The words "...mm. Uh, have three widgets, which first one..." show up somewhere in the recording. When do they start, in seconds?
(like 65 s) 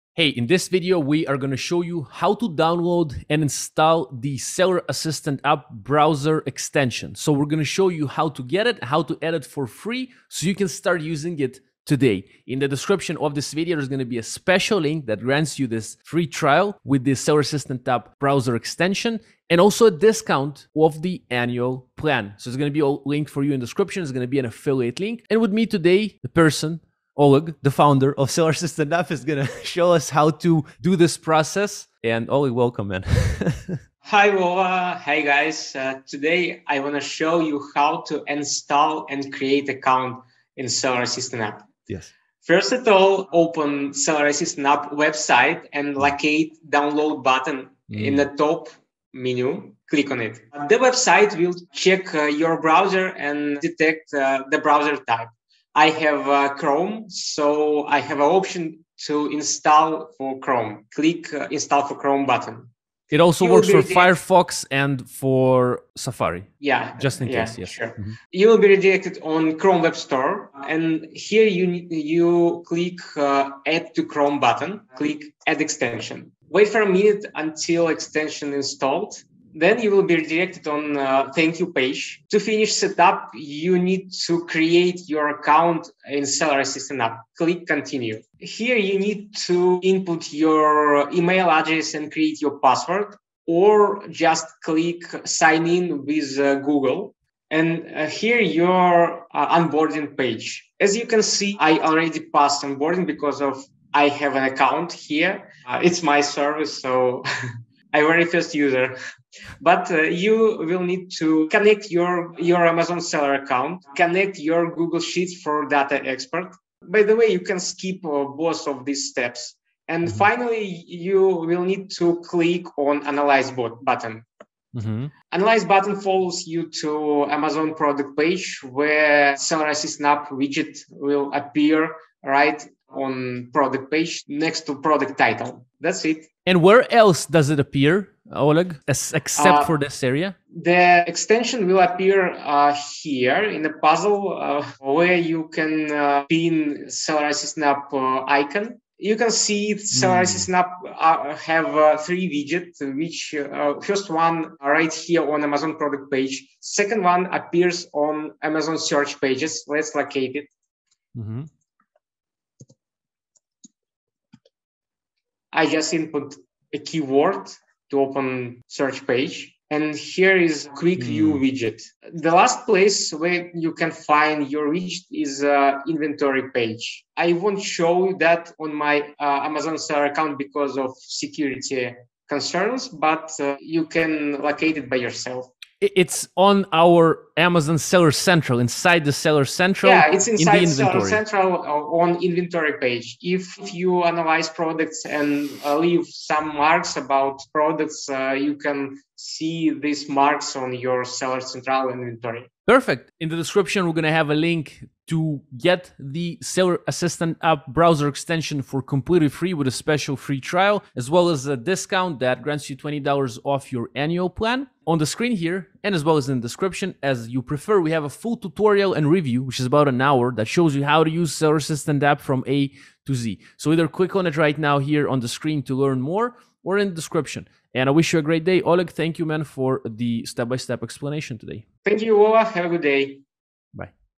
150 s.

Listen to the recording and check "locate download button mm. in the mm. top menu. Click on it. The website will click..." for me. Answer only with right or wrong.
wrong.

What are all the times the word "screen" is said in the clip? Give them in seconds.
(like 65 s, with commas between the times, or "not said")
215 s, 225 s.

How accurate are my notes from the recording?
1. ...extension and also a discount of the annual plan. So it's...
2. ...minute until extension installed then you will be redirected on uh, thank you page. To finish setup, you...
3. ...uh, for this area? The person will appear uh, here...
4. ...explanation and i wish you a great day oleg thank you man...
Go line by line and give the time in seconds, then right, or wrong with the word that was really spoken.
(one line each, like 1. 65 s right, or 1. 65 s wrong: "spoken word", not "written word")
1. 18 s right
2. 76 s right
3. 139 s wrong: "extension", not "person"
4. 226 s wrong: "description", not "explanation".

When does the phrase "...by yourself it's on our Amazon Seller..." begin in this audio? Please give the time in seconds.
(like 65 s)
184 s.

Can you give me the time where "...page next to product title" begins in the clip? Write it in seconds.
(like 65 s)
133 s.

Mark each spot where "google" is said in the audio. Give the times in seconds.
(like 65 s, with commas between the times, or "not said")
96 s, 114 s.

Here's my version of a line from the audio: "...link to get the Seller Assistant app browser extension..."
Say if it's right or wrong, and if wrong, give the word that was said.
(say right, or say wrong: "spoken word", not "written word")
right.